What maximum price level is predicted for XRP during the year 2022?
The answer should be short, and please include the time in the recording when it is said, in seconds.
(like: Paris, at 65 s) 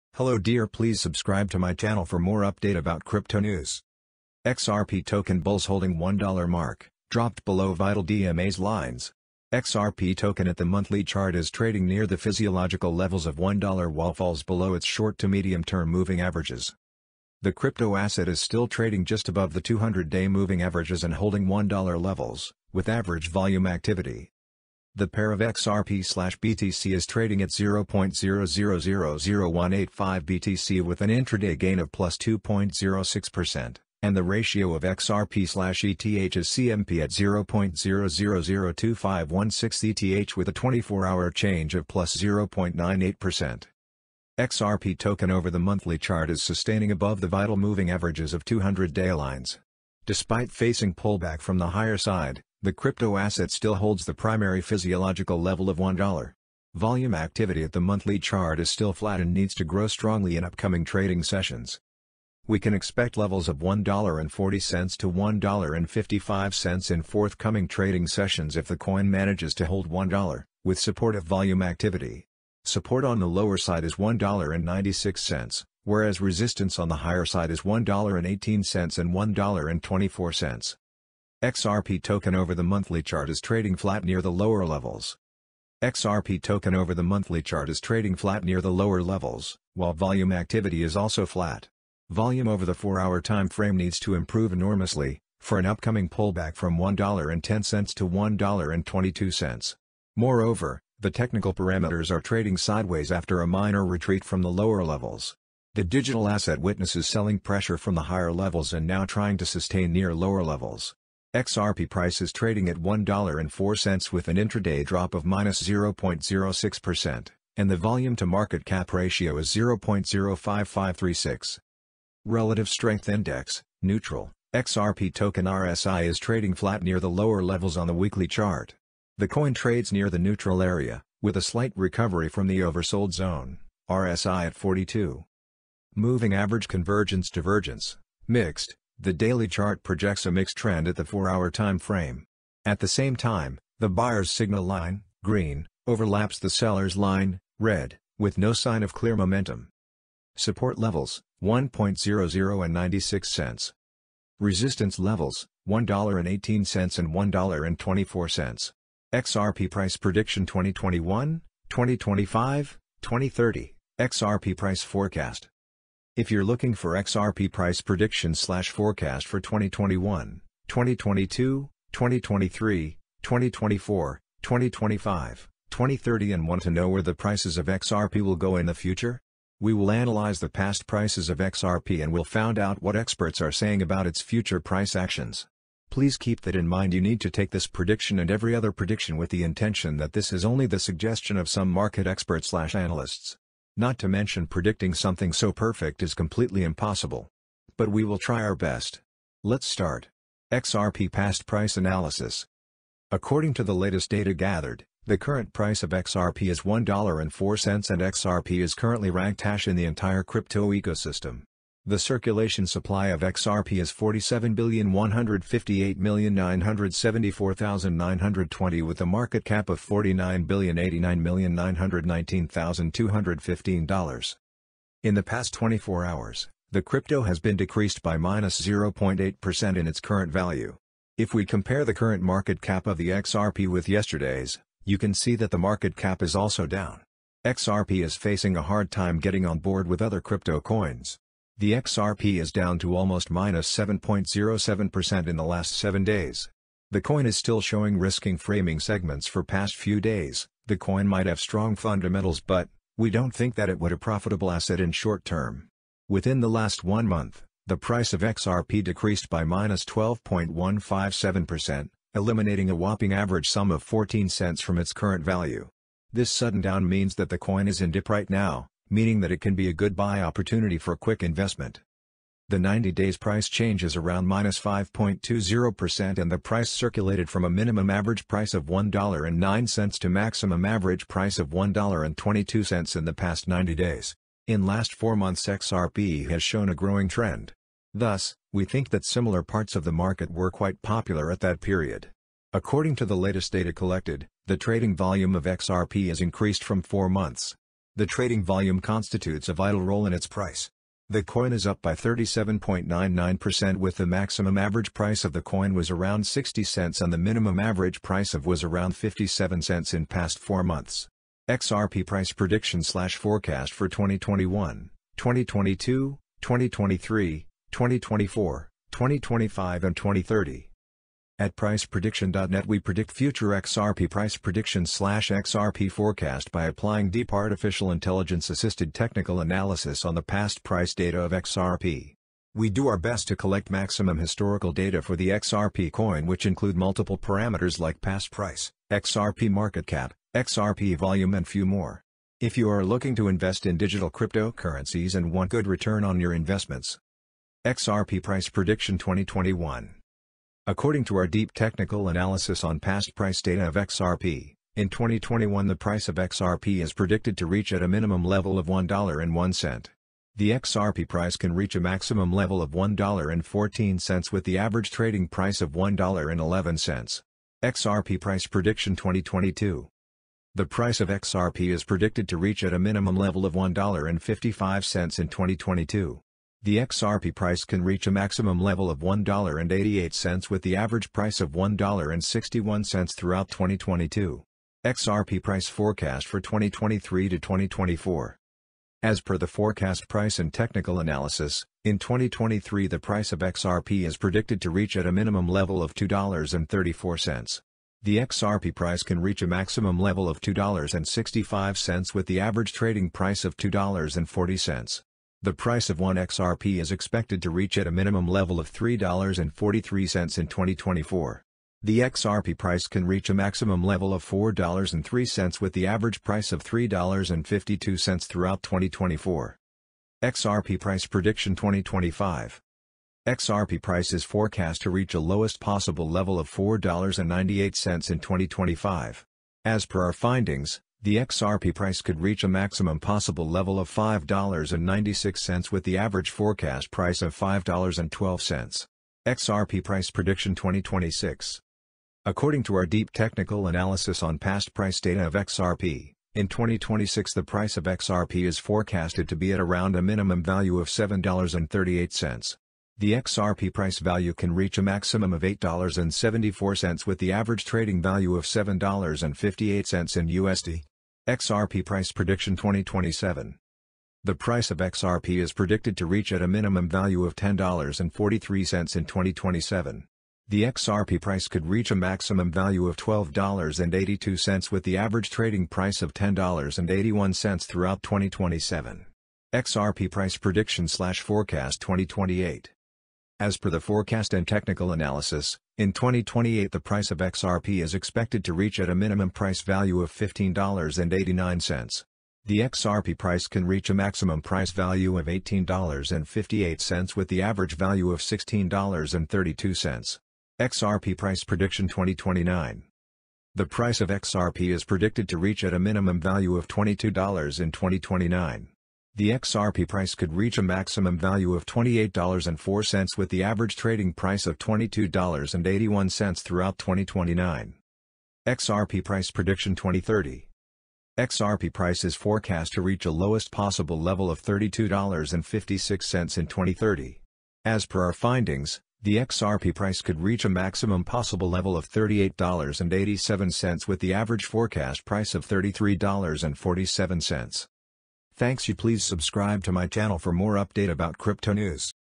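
$1.88, at 378 s.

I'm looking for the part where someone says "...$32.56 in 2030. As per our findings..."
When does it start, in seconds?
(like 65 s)
524 s.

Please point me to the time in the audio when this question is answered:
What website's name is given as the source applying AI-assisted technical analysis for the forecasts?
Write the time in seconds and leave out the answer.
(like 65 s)
321 s.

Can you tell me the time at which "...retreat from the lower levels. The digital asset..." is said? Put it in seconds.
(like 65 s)
103 s.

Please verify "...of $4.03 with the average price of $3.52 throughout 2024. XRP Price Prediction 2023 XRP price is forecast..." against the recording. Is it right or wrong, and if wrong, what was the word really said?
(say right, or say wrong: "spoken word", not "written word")
wrong: "2025", not "2023".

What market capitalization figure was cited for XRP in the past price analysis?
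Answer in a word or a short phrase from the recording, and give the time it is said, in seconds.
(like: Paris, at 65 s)
$49,089,919,215, at 219 s.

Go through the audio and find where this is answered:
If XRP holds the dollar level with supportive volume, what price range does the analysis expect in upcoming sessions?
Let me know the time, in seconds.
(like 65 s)
63 s.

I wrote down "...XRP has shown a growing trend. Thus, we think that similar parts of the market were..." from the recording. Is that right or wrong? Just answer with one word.
right.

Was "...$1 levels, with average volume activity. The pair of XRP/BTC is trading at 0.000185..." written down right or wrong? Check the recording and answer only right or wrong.
right.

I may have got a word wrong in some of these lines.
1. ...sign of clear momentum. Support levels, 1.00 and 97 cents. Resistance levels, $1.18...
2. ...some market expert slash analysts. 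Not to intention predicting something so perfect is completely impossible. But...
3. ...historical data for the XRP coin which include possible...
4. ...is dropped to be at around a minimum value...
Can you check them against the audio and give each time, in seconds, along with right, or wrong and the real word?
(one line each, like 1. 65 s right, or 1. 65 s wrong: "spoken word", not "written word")
1. 148 s wrong: "96", not "97"
2. 191 s wrong: "mention", not "intention"
3. 334 s wrong: "multiple", not "possible"
4. 448 s wrong: "forecasted", not "dropped".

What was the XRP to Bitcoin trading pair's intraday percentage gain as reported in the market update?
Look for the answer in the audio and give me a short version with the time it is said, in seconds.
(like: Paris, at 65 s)
2.06%, at 31 s.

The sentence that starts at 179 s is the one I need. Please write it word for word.
We will analyze the past prices of XRP and we'll find out what experts are saying about its future price actions.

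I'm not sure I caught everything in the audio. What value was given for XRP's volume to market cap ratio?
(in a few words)
0.05536.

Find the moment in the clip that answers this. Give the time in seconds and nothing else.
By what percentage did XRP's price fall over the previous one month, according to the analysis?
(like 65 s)
259 s.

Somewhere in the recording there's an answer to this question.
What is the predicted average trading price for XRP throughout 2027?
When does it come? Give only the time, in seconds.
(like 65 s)
476 s.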